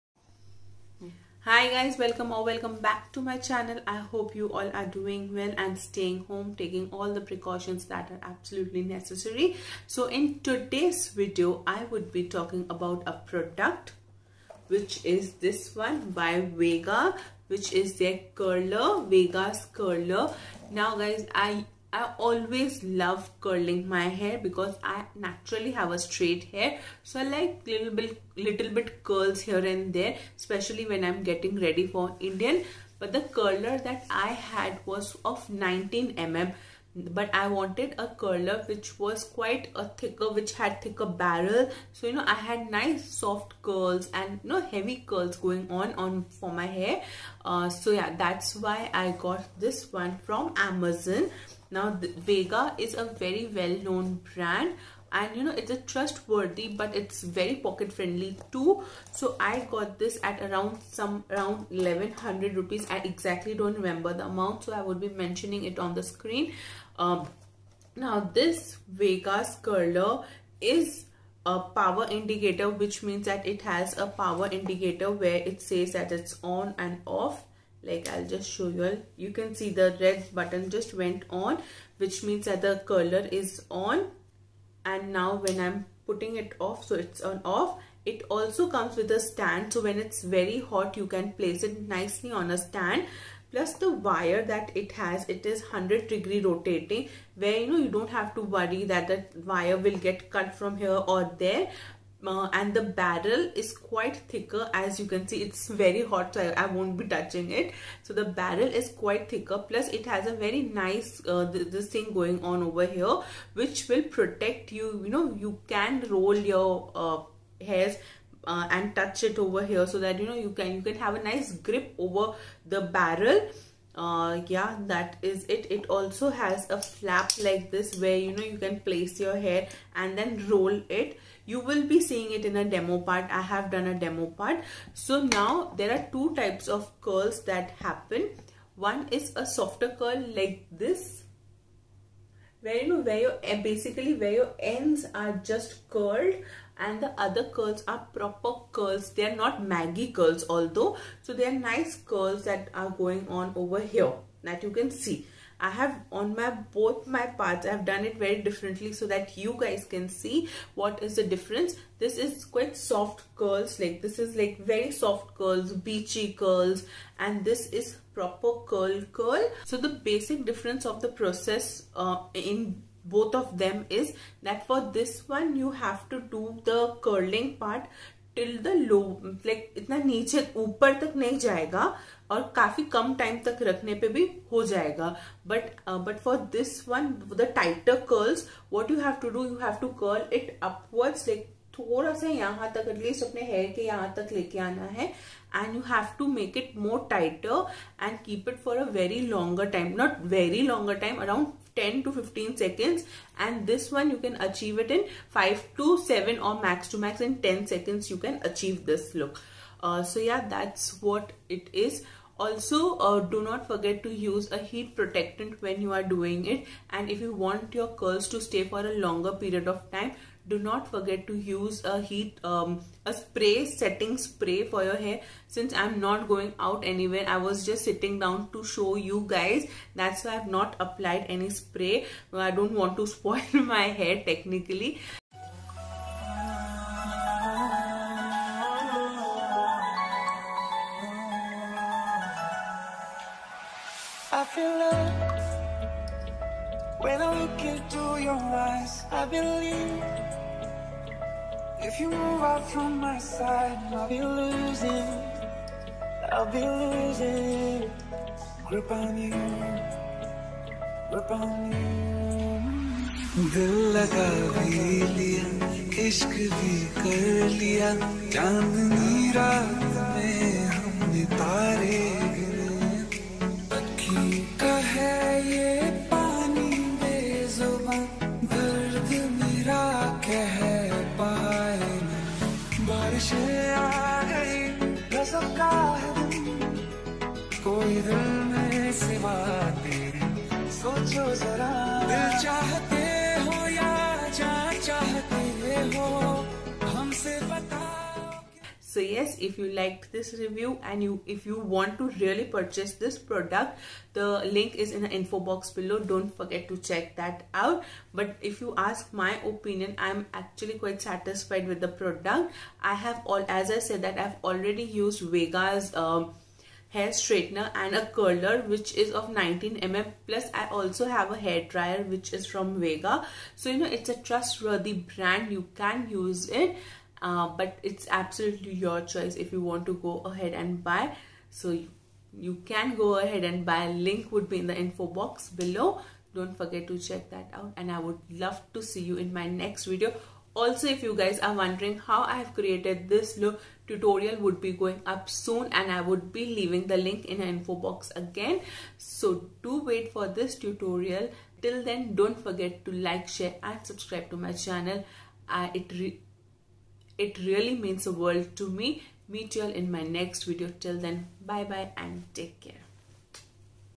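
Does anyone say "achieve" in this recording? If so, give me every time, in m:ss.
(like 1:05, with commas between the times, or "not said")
3:24, 3:28.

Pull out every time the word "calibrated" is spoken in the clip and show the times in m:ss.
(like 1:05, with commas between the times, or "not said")
not said.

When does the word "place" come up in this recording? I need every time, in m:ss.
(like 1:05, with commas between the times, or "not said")
1:31, 2:08.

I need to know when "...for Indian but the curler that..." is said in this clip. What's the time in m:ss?
0:31.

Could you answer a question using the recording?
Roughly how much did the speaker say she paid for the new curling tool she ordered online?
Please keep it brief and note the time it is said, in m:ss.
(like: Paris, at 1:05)
1100 rupees, at 1:01.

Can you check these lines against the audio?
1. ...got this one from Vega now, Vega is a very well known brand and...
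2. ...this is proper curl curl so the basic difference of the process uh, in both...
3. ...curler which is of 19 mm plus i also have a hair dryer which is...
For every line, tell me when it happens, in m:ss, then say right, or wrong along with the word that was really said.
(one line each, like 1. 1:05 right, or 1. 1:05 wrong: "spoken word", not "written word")
1. 0:49 wrong: "Amazon", not "Vega"
2. 2:47 right
3. 5:18 right.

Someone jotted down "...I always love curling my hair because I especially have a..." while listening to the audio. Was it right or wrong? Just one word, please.
wrong.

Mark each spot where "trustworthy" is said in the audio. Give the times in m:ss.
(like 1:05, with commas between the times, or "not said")
0:55, 5:24.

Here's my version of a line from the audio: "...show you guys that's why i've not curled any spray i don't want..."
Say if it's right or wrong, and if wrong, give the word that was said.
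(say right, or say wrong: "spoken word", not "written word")
wrong: "applied", not "curled".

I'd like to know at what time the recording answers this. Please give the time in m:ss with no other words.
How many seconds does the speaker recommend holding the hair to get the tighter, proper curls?
3:21.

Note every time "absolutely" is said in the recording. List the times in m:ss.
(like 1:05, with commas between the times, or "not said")
0:08, 5:28.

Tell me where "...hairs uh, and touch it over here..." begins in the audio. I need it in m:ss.
1:57.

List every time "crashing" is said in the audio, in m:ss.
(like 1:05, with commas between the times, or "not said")
not said.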